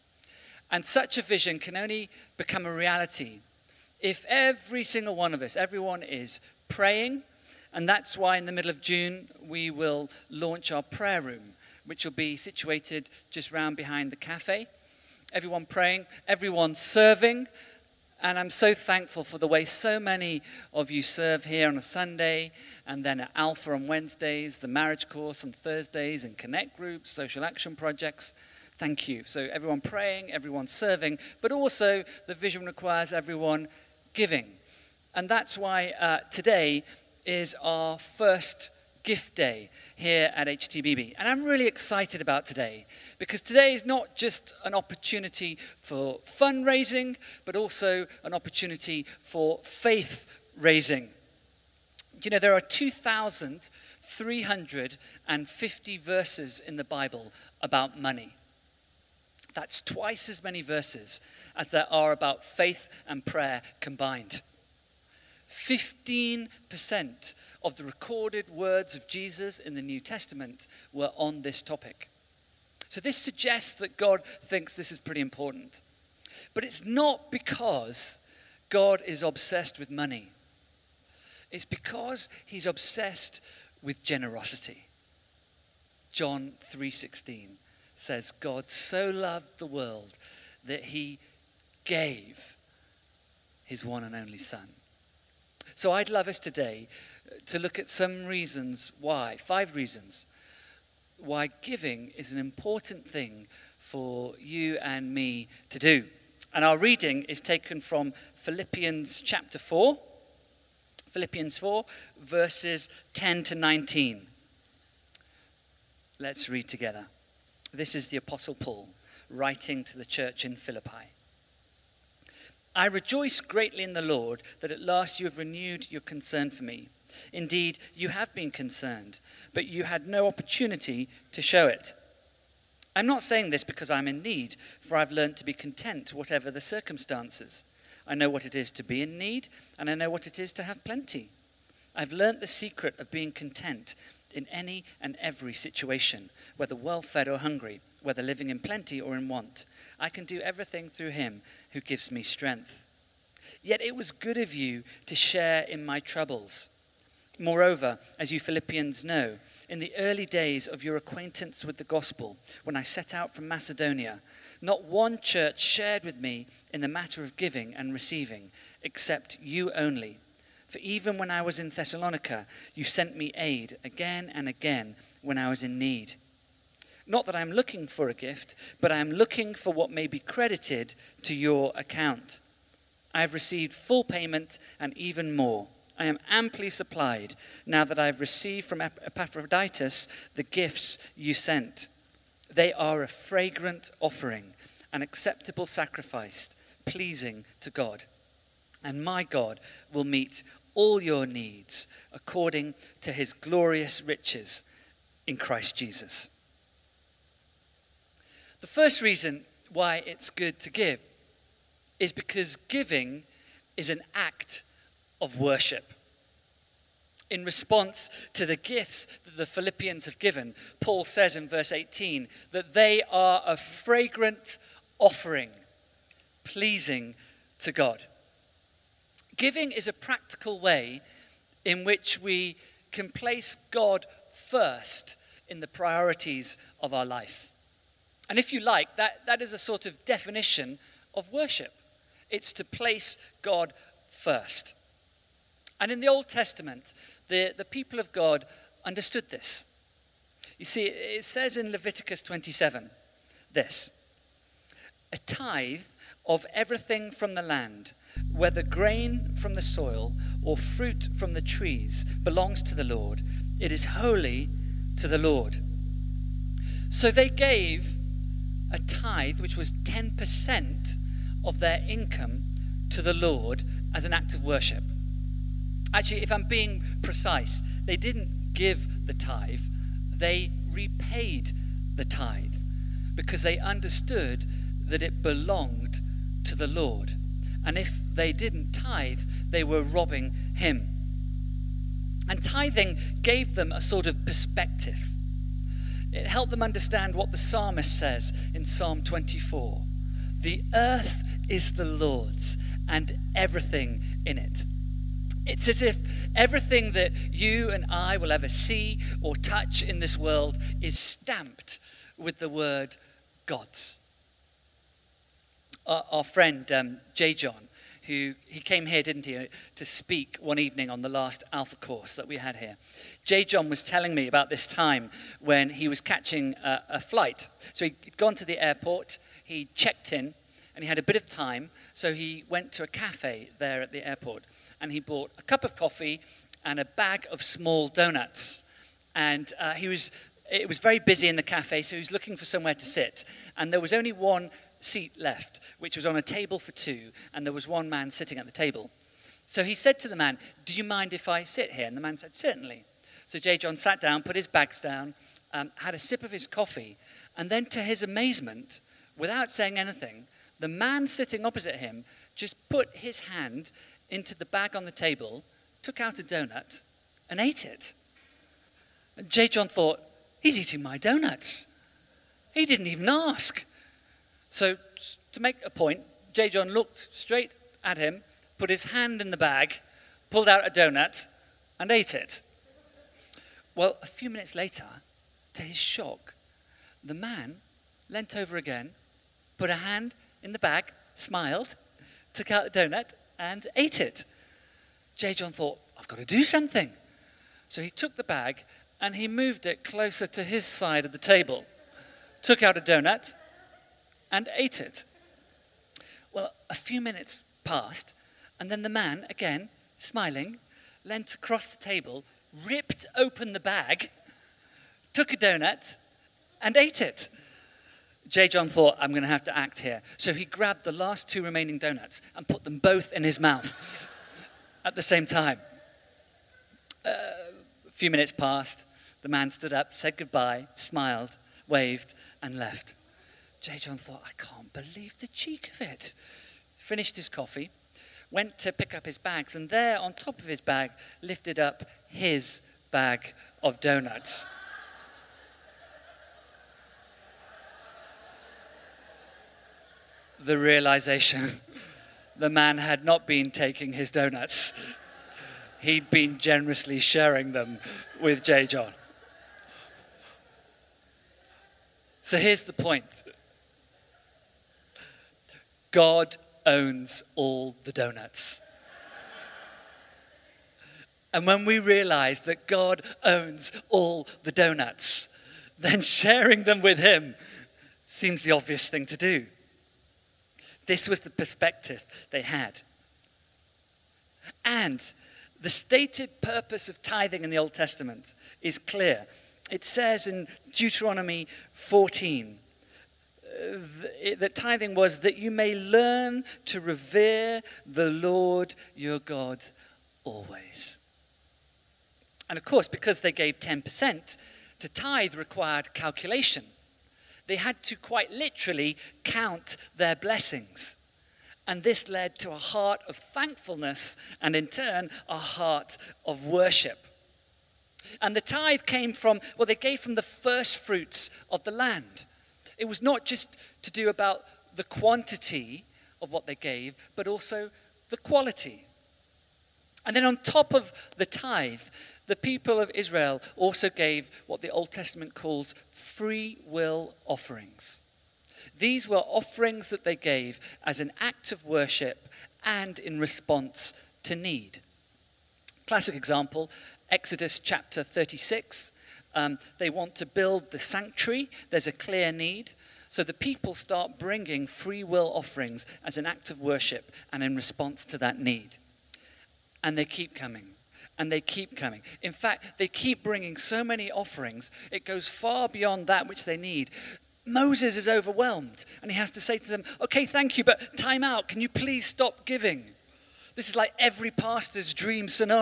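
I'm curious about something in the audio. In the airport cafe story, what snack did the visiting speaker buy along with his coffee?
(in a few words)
Small donuts.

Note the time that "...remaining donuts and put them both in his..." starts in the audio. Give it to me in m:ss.
7:01.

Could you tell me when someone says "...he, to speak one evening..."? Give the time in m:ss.
5:19.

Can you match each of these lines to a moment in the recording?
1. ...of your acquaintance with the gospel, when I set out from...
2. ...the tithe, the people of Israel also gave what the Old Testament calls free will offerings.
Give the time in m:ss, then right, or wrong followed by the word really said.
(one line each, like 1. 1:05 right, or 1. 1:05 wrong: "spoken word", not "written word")
1. 2:40 right
2. 8:51 right.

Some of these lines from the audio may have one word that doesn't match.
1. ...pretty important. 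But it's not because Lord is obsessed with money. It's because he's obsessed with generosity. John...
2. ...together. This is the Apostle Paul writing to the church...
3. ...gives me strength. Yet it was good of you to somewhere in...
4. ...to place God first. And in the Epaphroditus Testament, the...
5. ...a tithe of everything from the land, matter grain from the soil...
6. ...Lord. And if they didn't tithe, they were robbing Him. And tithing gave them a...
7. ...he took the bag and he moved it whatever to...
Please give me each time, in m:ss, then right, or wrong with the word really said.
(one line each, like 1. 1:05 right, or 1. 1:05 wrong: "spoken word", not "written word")
1. 1:14 wrong: "God", not "Lord"
2. 1:56 right
3. 2:31 wrong: "share", not "somewhere"
4. 4:02 wrong: "Old", not "Epaphroditus"
5. 4:15 wrong: "whether", not "matter"
6. 4:46 right
7. 6:37 wrong: "closer", not "whatever".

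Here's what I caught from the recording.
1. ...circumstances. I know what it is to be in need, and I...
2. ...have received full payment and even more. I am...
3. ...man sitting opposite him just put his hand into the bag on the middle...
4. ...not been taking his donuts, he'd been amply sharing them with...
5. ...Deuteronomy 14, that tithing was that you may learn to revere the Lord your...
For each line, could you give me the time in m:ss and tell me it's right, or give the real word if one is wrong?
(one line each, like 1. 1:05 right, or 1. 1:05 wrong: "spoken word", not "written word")
1. 2:16 right
2. 3:03 right
3. 6:00 wrong: "table", not "middle"
4. 7:33 wrong: "generously", not "amply"
5. 8:10 right.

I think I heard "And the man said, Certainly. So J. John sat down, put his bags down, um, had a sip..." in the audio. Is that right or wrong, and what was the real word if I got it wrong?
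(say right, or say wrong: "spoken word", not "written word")
right.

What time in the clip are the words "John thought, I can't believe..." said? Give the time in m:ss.
7:13.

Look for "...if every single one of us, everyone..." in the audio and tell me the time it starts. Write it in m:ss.
0:03.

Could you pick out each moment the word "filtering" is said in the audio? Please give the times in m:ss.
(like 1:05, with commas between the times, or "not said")
not said.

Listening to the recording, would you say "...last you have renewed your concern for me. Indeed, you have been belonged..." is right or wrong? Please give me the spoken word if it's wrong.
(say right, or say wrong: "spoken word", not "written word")
wrong: "concerned", not "belonged".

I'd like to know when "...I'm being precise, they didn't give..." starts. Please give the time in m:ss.
4:36.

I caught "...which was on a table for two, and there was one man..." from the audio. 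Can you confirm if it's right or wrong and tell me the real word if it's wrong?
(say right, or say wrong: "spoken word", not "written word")
right.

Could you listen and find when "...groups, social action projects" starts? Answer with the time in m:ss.
0:26.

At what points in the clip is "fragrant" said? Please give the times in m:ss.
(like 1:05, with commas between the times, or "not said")
3:13, 3:43.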